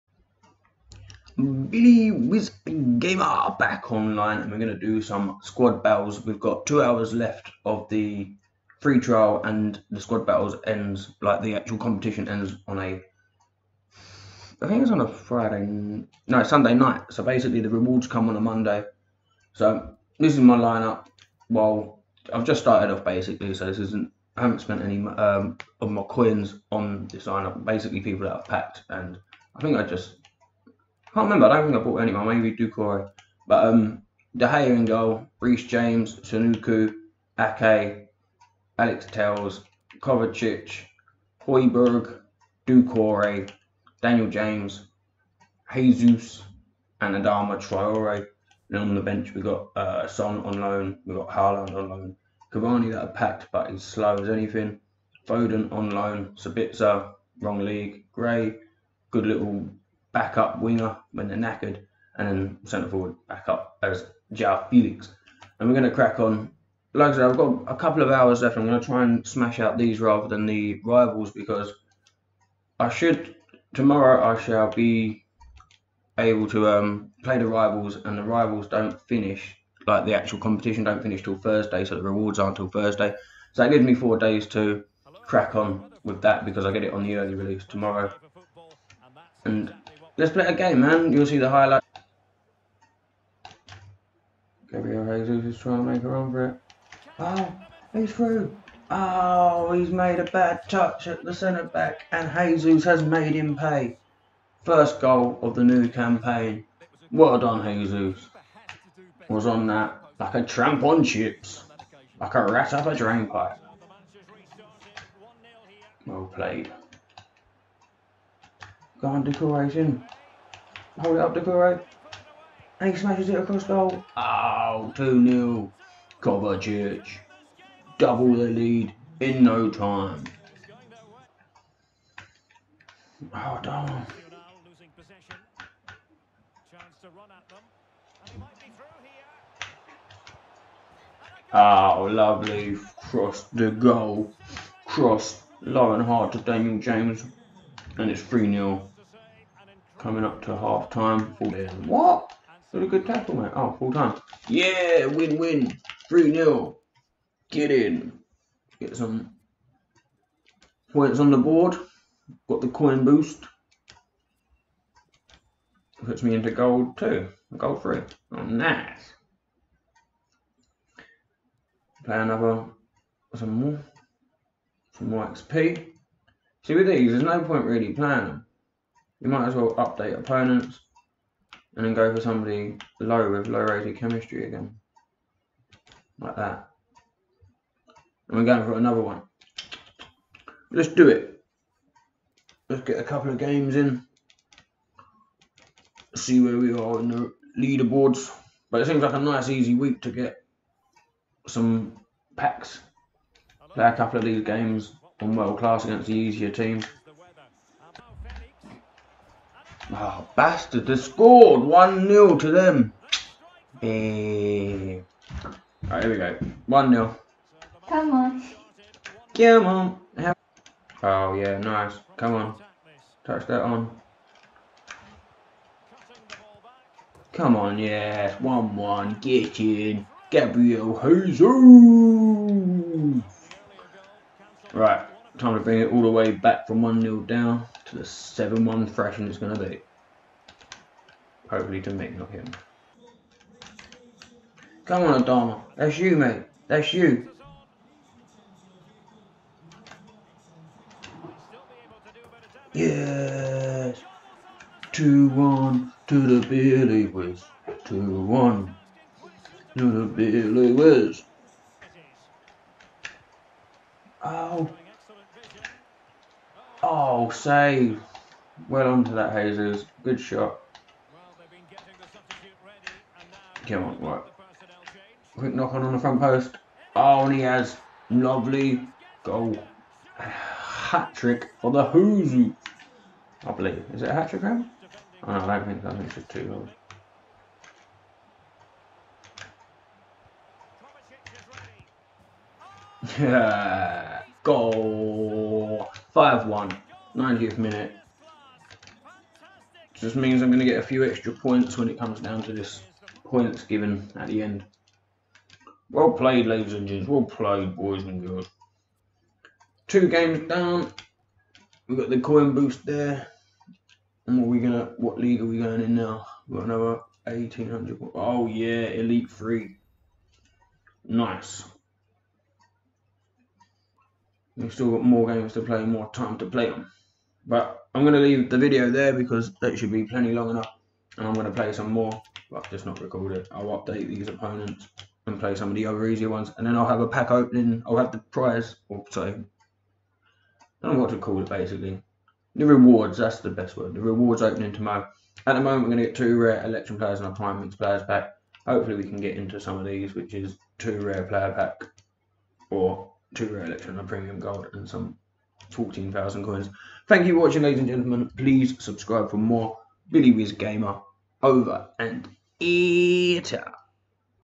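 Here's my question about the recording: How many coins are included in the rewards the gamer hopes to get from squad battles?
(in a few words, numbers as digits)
14,000.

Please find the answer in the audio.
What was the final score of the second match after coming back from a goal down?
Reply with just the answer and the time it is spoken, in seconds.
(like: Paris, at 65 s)
5-1, at 296 s.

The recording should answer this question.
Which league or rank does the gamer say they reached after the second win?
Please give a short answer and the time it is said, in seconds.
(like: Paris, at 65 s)
Elite 3, at 318 s.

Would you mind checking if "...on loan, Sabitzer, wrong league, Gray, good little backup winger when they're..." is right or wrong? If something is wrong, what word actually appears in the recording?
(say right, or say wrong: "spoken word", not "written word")
right.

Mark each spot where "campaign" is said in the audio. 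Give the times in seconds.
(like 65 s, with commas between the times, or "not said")
105 s.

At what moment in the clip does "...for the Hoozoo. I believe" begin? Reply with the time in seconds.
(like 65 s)
281 s.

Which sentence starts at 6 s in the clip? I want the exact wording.
We've got two hours left of the free trial, and the squad battles ends like the actual competition ends on a.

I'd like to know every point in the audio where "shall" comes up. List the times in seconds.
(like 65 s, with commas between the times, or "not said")
74 s.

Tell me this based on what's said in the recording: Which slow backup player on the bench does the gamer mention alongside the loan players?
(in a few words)
Cavani.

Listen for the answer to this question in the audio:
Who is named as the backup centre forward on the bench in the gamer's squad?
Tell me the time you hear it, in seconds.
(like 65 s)
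64 s.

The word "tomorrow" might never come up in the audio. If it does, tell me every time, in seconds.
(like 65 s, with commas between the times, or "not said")
73 s, 87 s, 344 s.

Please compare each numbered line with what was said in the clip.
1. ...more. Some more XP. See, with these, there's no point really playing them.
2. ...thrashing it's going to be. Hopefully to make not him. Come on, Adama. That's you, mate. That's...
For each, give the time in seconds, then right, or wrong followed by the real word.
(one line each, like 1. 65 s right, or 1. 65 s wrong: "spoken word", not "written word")
1. 173 s right
2. 238 s right.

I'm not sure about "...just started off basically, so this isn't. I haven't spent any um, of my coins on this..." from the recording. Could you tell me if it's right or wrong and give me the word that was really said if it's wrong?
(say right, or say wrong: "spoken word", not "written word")
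right.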